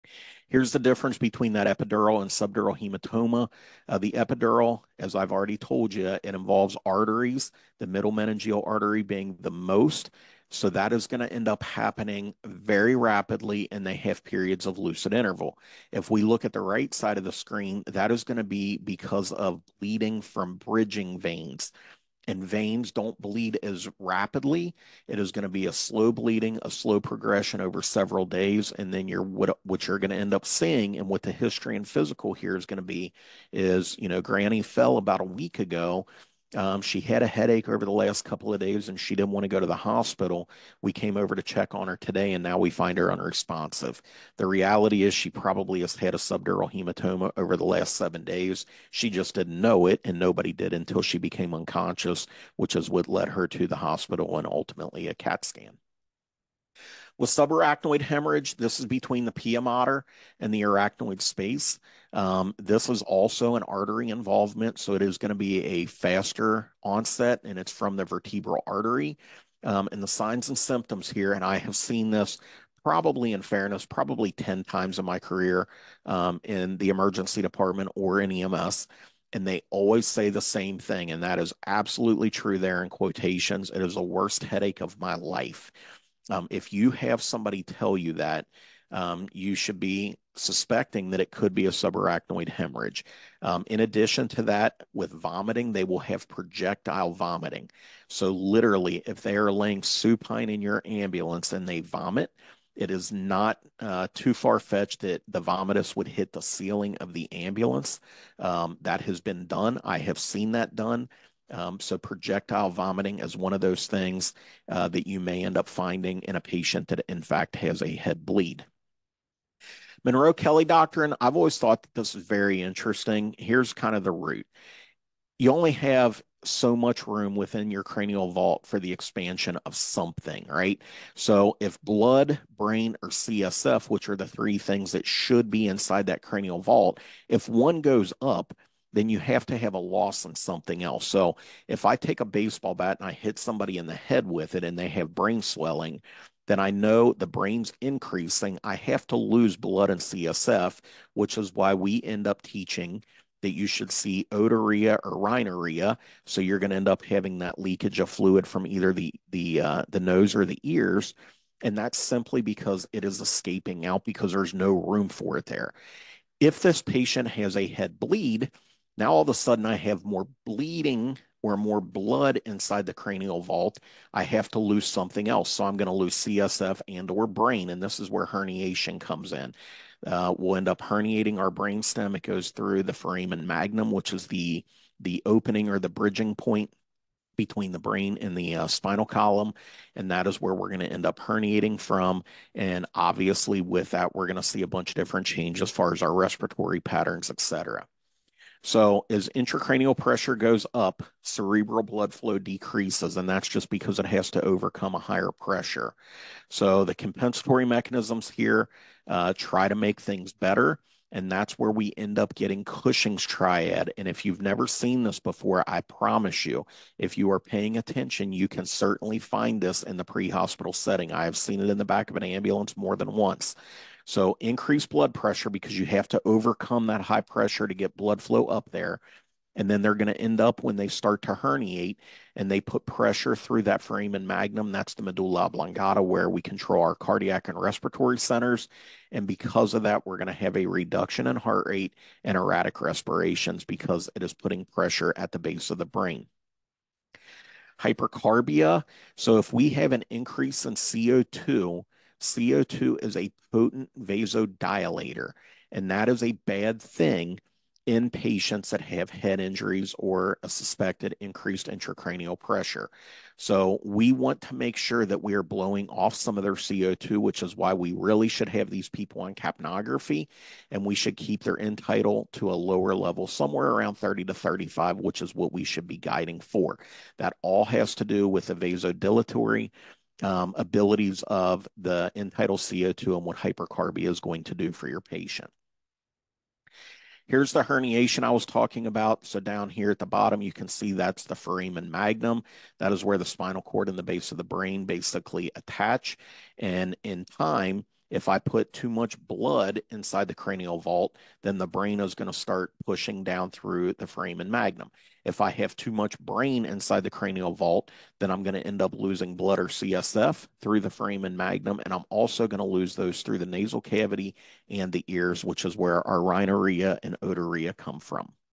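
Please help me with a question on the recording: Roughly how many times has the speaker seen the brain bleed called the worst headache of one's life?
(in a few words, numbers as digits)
10.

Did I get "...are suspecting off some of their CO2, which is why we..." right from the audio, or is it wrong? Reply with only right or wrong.
wrong.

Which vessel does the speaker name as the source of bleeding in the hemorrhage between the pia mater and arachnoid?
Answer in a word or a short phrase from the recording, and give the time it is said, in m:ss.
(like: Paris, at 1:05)
vertebral artery, at 1:08.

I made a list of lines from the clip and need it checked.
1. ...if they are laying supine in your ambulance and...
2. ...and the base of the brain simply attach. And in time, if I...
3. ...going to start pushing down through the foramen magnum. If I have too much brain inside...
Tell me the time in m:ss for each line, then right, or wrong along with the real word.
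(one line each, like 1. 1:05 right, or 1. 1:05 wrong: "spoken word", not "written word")
1. 1:39 right
2. 4:53 wrong: "basically", not "simply"
3. 5:02 right.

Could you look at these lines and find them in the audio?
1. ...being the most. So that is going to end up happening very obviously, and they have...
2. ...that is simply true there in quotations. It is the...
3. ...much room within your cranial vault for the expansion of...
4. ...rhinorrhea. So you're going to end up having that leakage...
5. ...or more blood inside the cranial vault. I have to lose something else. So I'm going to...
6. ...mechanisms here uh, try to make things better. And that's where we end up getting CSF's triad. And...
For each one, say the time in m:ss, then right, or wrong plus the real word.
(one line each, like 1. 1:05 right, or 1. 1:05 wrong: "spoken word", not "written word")
1. 0:09 wrong: "rapidly", not "obviously"
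2. 1:21 wrong: "absolutely", not "simply"
3. 2:06 right
4. 2:35 right
5. 2:51 right
6. 3:27 wrong: "Cushing", not "CSF".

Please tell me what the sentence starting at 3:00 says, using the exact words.
Uh, we'll end up herniating our brainstem.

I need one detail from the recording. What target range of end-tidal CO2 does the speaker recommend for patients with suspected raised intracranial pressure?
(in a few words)
30 to 35.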